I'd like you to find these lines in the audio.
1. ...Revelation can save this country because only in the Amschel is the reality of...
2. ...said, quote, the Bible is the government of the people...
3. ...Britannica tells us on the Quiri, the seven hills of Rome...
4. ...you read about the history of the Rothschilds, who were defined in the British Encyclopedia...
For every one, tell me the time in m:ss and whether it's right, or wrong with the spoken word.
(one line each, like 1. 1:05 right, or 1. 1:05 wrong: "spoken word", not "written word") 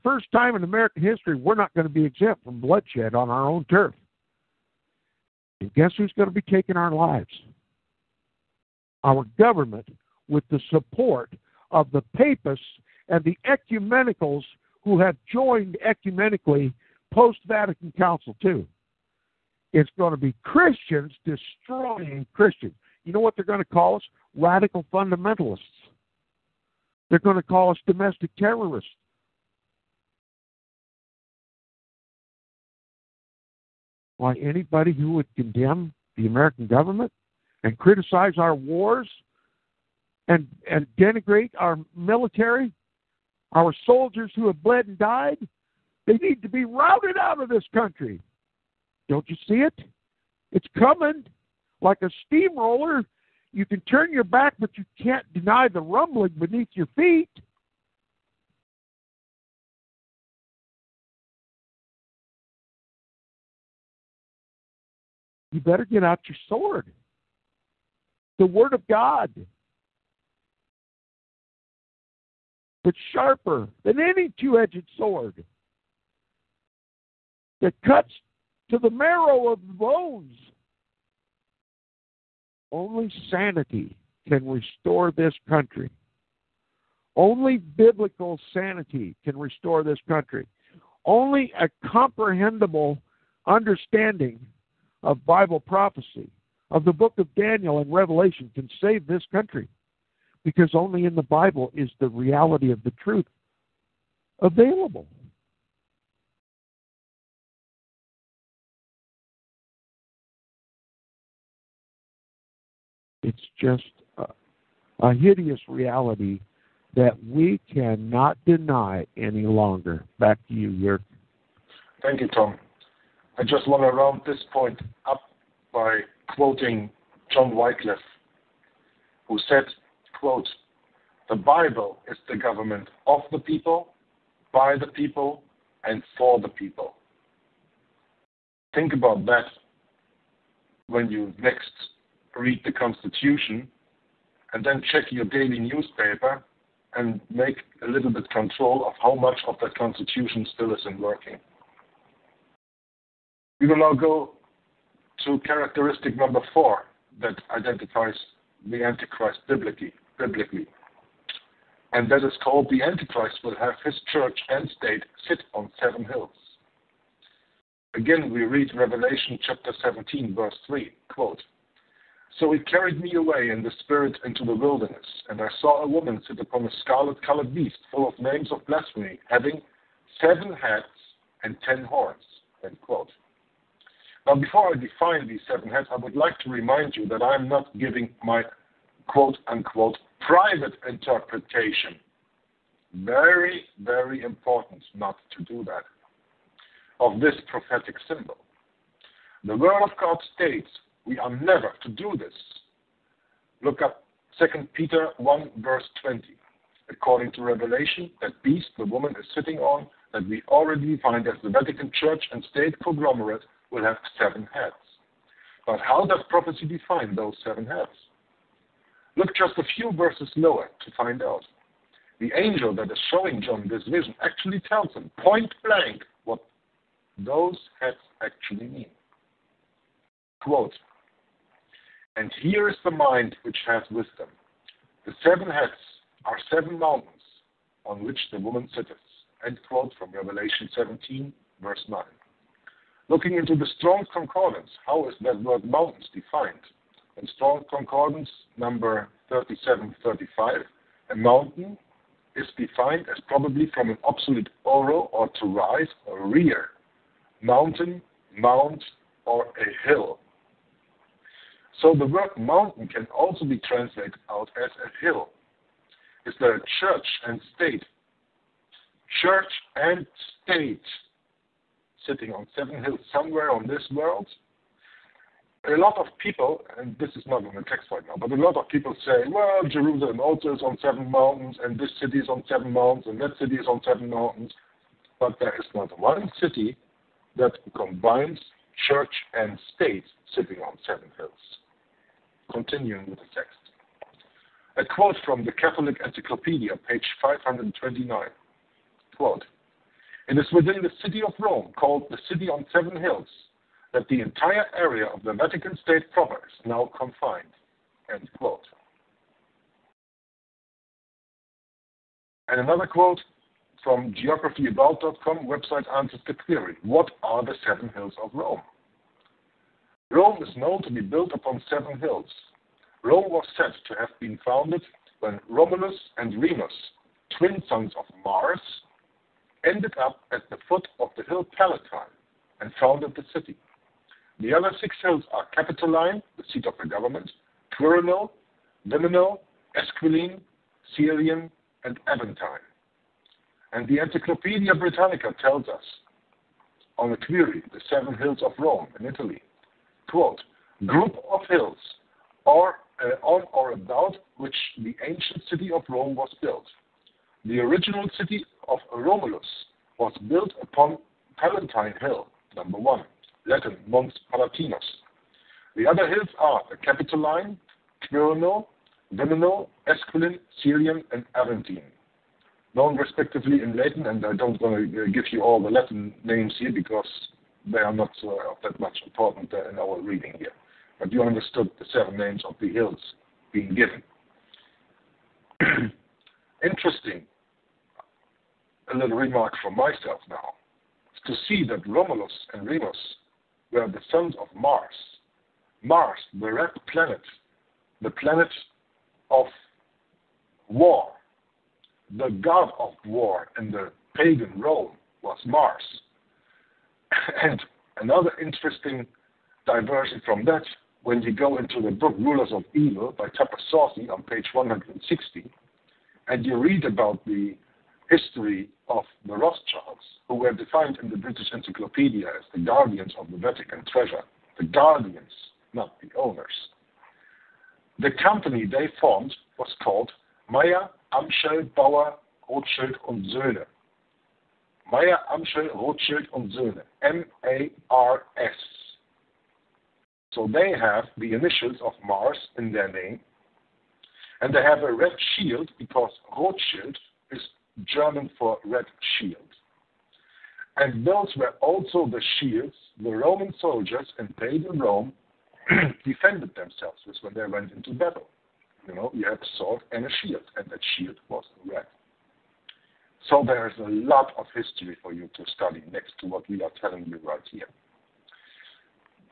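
1. 1:37 wrong: "Bible", not "Amschel"
2. 2:09 right
3. 5:44 right
4. 6:56 right.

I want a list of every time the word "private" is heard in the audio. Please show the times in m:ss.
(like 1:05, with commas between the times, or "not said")
3:10.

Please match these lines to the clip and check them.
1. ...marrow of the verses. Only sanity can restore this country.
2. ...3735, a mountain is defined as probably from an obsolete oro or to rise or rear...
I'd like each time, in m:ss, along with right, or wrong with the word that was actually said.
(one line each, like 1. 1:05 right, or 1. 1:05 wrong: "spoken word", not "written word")
1. 1:18 wrong: "bones", not "verses"
2. 4:09 right.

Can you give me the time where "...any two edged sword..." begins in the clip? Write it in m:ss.
1:13.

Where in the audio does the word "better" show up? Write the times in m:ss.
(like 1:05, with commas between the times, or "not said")
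1:05.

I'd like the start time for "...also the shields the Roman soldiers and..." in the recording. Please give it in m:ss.
7:31.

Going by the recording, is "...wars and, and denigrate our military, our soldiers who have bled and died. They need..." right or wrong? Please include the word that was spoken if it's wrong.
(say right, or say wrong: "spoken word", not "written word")
right.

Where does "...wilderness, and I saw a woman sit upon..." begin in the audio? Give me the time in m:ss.
2:54.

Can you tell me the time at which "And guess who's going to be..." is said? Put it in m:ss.
0:05.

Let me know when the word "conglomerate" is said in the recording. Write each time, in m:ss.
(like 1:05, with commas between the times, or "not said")
3:32.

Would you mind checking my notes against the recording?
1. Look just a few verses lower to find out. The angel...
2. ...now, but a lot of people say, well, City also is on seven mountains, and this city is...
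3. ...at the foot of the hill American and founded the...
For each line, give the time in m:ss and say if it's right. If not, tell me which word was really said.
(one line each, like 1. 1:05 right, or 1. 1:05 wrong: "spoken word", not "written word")
1. 3:39 right
2. 4:38 wrong: "Jerusalem", not "City"
3. 5:30 wrong: "Palatine", not "American".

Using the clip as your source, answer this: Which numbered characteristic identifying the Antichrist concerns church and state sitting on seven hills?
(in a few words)
4.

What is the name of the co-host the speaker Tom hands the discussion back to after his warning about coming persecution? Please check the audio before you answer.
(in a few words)
Jörg.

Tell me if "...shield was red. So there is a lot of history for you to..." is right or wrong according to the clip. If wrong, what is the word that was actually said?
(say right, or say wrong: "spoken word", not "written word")
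right.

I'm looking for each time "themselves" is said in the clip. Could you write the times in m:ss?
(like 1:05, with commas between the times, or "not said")
7:36.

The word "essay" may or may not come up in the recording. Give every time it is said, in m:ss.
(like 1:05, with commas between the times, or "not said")
not said.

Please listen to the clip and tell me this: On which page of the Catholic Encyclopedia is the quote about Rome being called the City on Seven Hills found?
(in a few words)
529.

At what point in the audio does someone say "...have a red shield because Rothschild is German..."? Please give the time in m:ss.
7:24.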